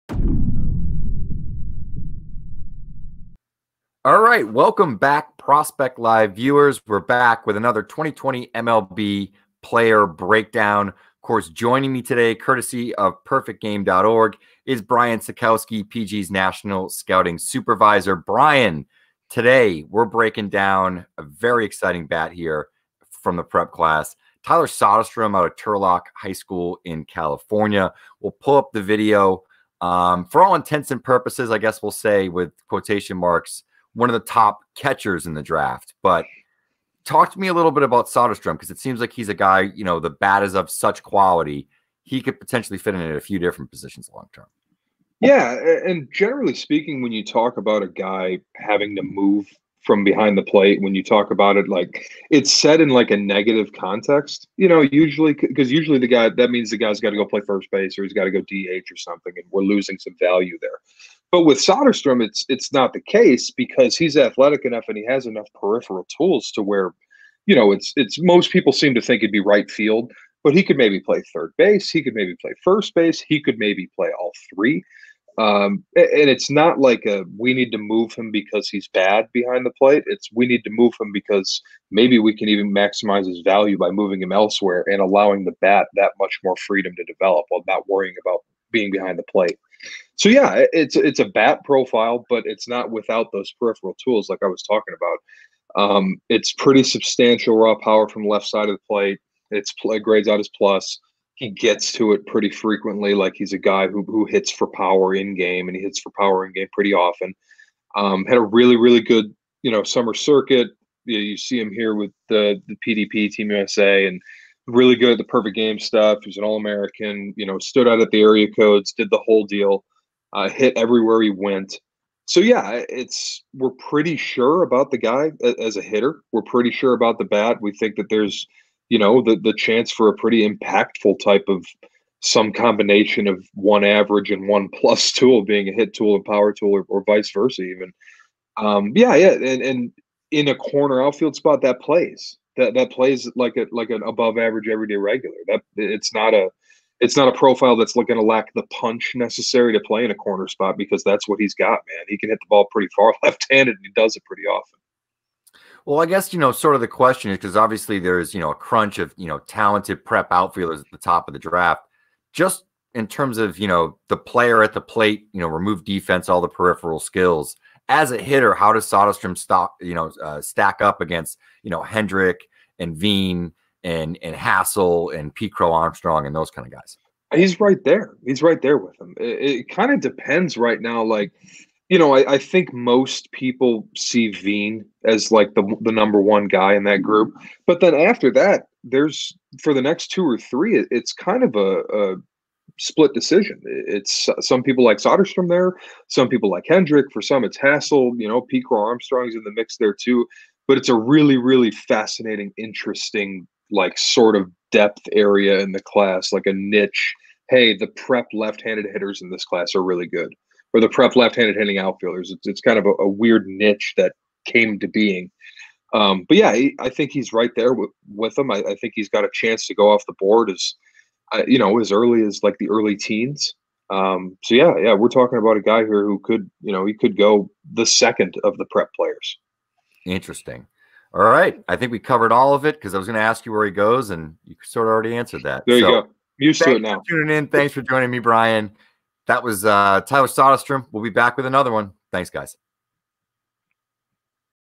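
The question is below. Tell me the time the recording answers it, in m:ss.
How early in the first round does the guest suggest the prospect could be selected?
3:42.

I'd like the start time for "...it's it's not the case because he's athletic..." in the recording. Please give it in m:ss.
1:02.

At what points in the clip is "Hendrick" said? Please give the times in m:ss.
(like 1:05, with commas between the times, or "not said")
2:51, 3:16.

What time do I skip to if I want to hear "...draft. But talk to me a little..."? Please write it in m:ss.
0:35.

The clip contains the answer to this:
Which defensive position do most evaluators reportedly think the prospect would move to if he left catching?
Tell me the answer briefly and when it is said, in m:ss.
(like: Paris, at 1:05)
right field, at 1:09.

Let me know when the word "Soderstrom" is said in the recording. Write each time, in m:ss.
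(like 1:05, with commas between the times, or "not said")
0:24, 0:38, 1:01, 2:48, 3:14, 4:00.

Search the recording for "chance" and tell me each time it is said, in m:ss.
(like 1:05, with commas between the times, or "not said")
2:09, 3:39.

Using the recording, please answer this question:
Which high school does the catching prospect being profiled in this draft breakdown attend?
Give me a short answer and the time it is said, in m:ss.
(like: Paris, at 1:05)
Turlock High School, at 0:25.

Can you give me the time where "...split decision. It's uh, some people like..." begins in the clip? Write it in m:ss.
3:12.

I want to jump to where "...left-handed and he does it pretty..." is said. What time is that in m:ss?
2:33.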